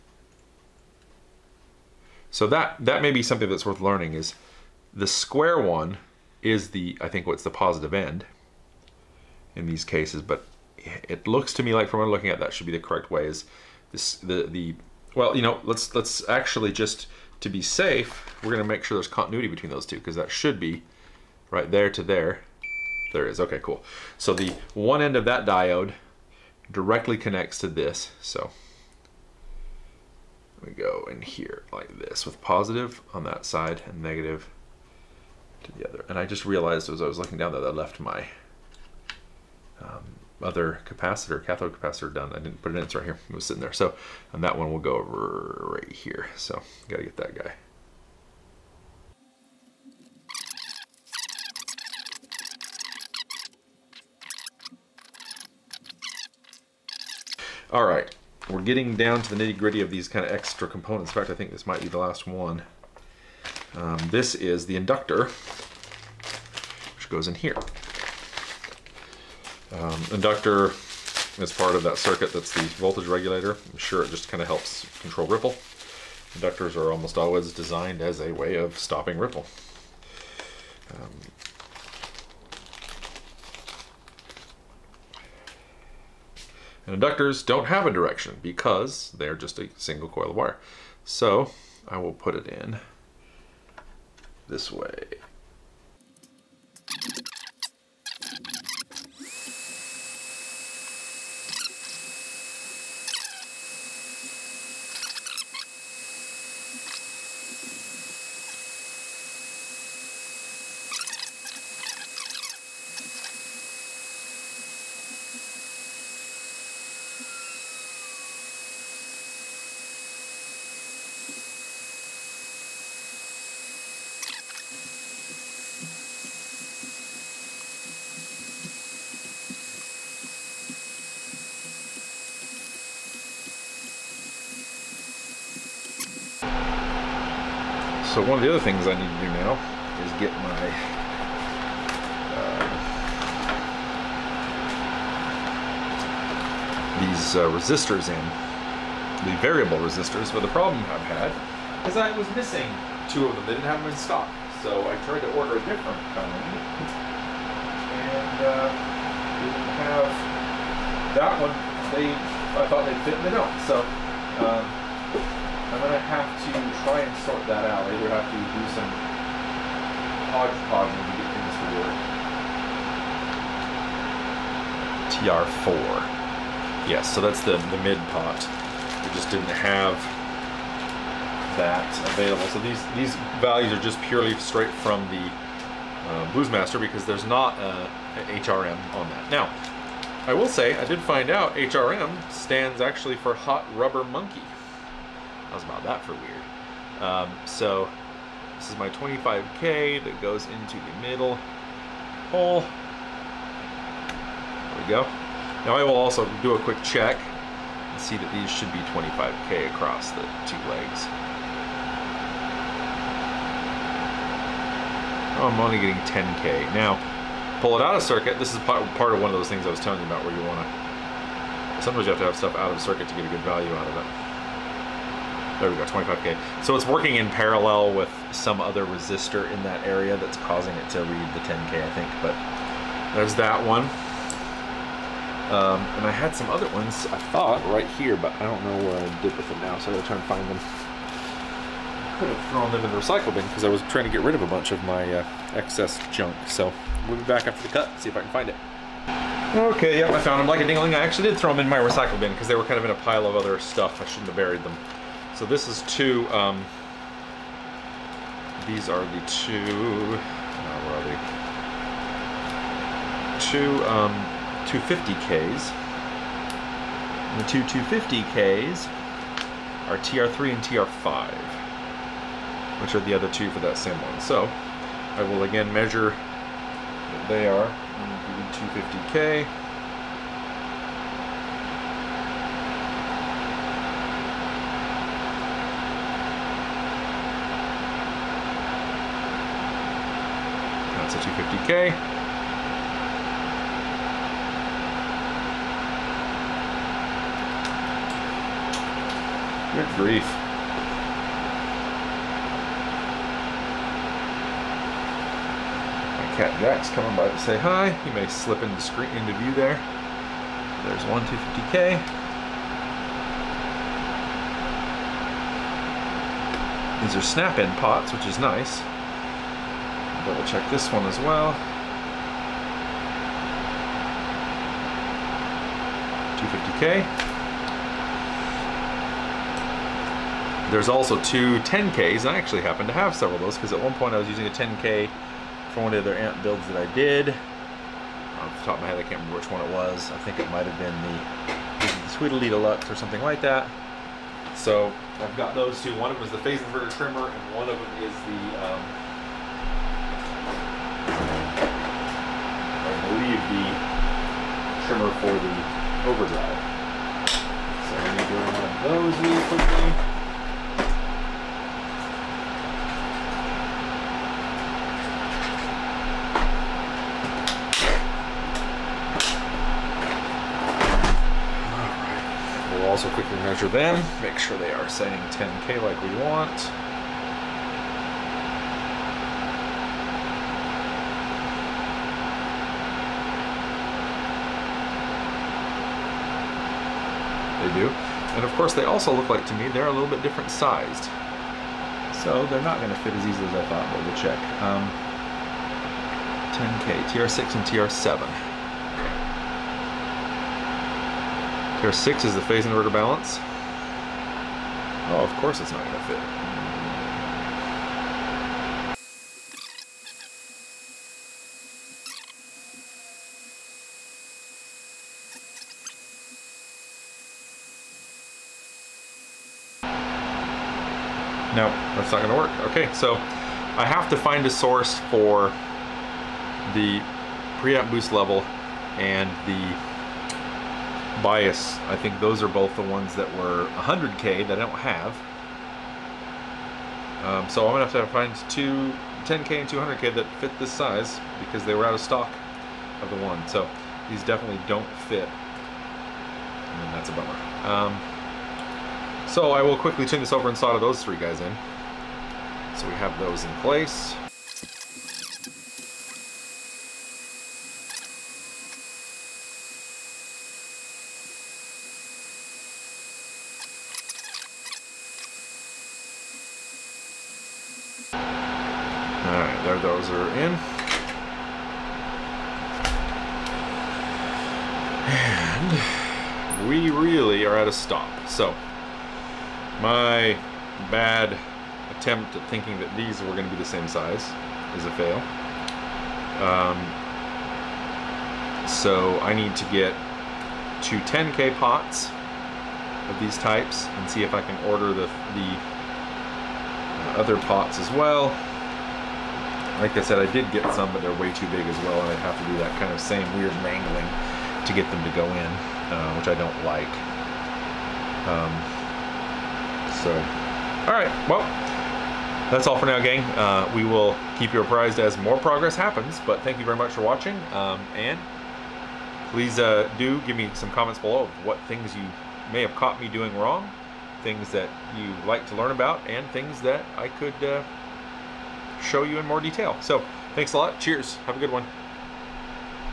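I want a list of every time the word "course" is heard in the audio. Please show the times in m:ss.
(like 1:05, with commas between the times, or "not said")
6:28, 6:45.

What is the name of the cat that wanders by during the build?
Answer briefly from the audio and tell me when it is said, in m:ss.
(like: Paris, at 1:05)
Jack, at 5:06.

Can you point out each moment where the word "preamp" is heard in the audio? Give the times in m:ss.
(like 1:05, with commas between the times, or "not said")
7:07.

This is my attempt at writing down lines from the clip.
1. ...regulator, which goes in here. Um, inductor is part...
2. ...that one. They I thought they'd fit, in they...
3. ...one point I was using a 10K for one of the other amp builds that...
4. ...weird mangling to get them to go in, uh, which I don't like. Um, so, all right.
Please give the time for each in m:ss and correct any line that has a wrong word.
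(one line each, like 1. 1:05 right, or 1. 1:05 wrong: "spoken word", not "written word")
1. 1:04 wrong: "inductor", not "regulator"
2. 2:41 right
3. 5:33 right
4. 8:23 right.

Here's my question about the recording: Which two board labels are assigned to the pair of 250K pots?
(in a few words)
TR3 and TR5.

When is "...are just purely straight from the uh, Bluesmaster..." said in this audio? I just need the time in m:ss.
3:03.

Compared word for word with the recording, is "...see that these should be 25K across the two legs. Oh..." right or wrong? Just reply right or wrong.
right.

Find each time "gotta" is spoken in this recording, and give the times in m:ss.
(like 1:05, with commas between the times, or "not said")
0:46, 3:59.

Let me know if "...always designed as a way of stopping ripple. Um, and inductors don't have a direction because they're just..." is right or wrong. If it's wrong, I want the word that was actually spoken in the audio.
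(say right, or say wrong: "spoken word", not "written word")
right.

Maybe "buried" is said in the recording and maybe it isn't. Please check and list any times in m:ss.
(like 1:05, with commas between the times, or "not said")
4:14.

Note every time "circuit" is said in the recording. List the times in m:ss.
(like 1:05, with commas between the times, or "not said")
1:11, 3:38, 3:42.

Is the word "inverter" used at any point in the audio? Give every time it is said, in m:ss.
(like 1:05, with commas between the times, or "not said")
5:46, 6:42.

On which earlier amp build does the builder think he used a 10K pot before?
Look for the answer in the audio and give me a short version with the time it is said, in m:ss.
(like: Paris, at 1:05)
Tweedledee Deluxe, at 5:42.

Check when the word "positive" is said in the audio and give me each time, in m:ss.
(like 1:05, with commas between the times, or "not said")
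0:07, 0:32.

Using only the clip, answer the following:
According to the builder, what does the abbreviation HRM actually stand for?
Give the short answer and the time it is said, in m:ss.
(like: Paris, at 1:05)
Hot Rubber Monkey, at 3:13.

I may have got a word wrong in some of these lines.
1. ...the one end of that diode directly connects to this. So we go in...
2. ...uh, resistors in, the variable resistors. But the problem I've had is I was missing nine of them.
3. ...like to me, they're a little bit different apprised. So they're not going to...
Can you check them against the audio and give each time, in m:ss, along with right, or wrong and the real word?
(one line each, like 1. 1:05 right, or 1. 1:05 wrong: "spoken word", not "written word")
1. 0:24 right
2. 2:27 wrong: "two", not "nine"
3. 6:29 wrong: "sized", not "apprised".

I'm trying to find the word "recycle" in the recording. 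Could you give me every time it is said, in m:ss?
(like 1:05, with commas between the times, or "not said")
4:02, 4:11.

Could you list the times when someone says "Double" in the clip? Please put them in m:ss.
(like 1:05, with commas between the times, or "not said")
5:20.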